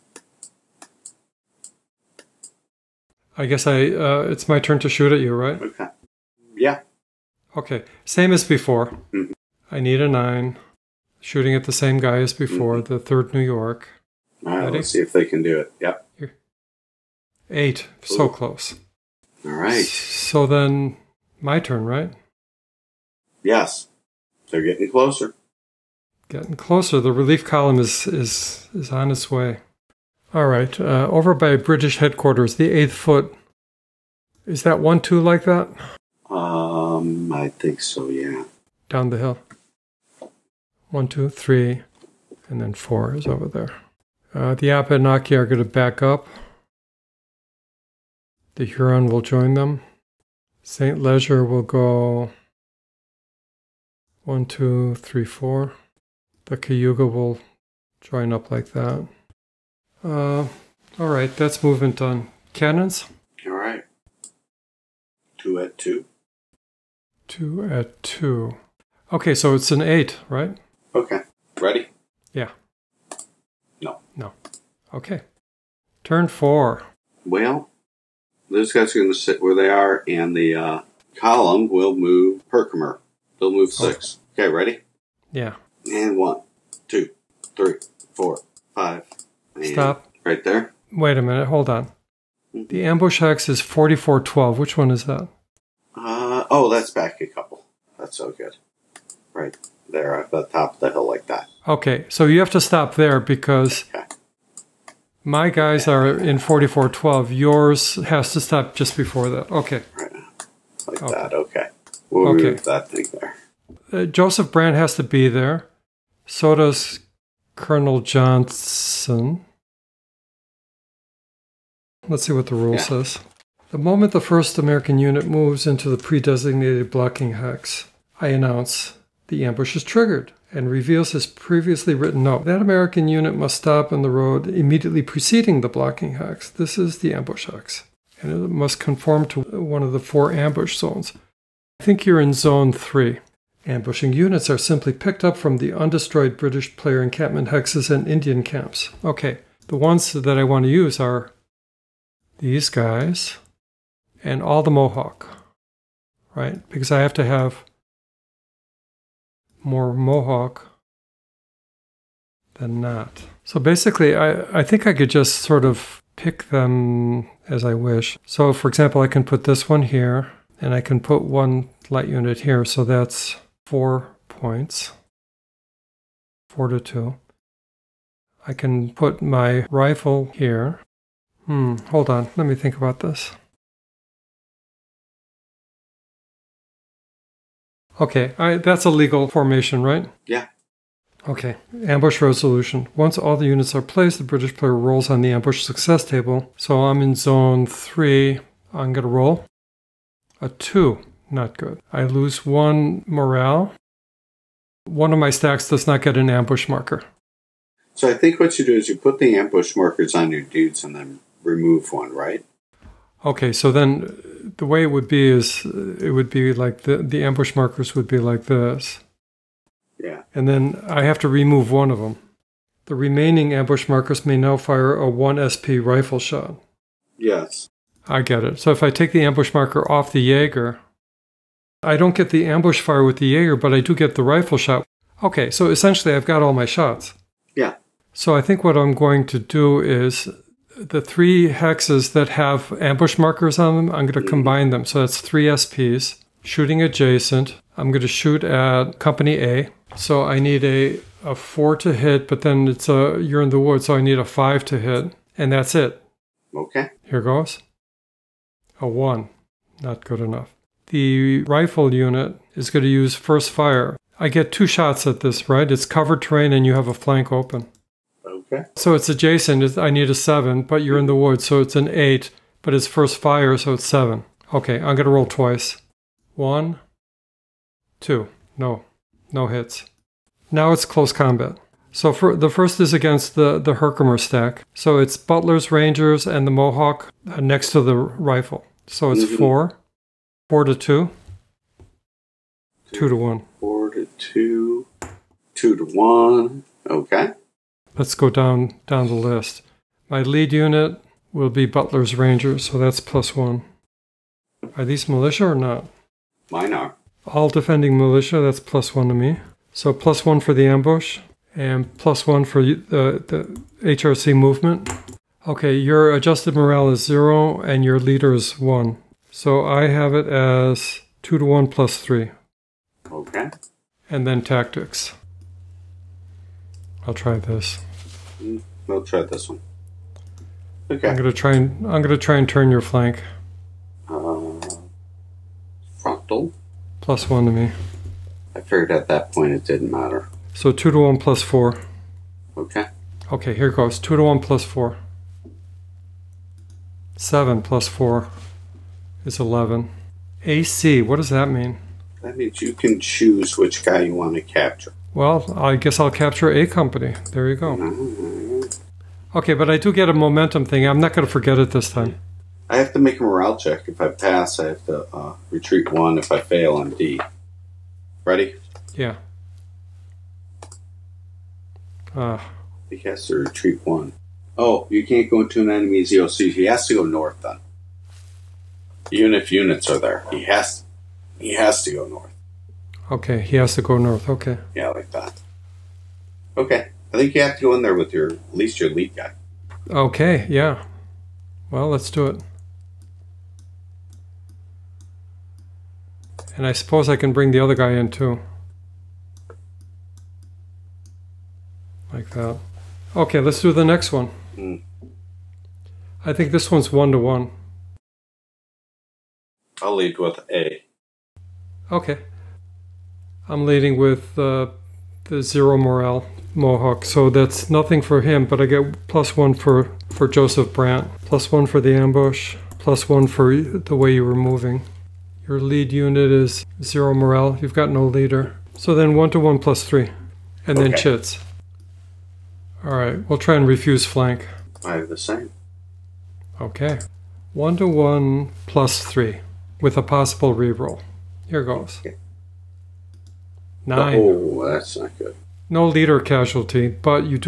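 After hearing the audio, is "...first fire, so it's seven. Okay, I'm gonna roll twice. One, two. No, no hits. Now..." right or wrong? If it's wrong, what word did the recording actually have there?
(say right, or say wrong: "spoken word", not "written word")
right.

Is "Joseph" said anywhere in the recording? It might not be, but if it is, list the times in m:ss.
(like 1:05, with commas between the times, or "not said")
1:54, 7:00.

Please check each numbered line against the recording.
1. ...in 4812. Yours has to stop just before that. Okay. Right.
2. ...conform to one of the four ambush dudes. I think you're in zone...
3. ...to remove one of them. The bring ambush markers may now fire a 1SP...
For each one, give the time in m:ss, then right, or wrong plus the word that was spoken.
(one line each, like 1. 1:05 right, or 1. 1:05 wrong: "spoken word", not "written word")
1. 1:46 wrong: "4412", not "4812"
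2. 2:18 wrong: "zones", not "dudes"
3. 3:41 wrong: "remaining", not "bring".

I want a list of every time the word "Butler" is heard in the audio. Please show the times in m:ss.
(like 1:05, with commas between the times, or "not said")
4:45, 5:01.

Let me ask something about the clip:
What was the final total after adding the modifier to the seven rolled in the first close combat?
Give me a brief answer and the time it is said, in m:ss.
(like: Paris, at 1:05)
11, at 5:49.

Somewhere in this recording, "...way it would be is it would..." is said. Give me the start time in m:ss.
3:34.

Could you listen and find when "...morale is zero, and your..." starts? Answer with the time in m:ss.
5:16.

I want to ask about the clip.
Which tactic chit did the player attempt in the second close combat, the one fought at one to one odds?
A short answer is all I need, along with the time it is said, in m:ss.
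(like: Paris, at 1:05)
Refuse flank, at 7:13.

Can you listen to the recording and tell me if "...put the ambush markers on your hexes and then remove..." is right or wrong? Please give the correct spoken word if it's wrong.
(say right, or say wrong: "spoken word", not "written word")
wrong: "dudes", not "hexes".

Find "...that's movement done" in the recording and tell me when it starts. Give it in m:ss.
1:01.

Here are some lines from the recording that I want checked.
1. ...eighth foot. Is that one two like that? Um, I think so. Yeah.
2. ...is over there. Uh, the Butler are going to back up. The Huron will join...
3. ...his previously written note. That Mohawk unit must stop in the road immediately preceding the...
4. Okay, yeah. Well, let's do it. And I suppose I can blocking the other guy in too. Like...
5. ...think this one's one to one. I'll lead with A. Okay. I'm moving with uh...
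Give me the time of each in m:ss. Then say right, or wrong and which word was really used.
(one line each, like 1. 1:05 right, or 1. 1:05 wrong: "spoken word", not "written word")
1. 0:32 right
2. 0:43 wrong: "Abenaki", not "Butler"
3. 2:11 wrong: "American", not "Mohawk"
4. 6:29 wrong: "bring", not "blocking"
5. 6:46 wrong: "leading", not "moving".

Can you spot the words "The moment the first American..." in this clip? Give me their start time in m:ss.
2:03.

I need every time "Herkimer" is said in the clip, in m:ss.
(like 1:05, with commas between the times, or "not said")
1:22, 4:43.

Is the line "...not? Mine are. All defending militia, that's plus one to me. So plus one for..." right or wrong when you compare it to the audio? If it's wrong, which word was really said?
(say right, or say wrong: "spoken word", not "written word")
right.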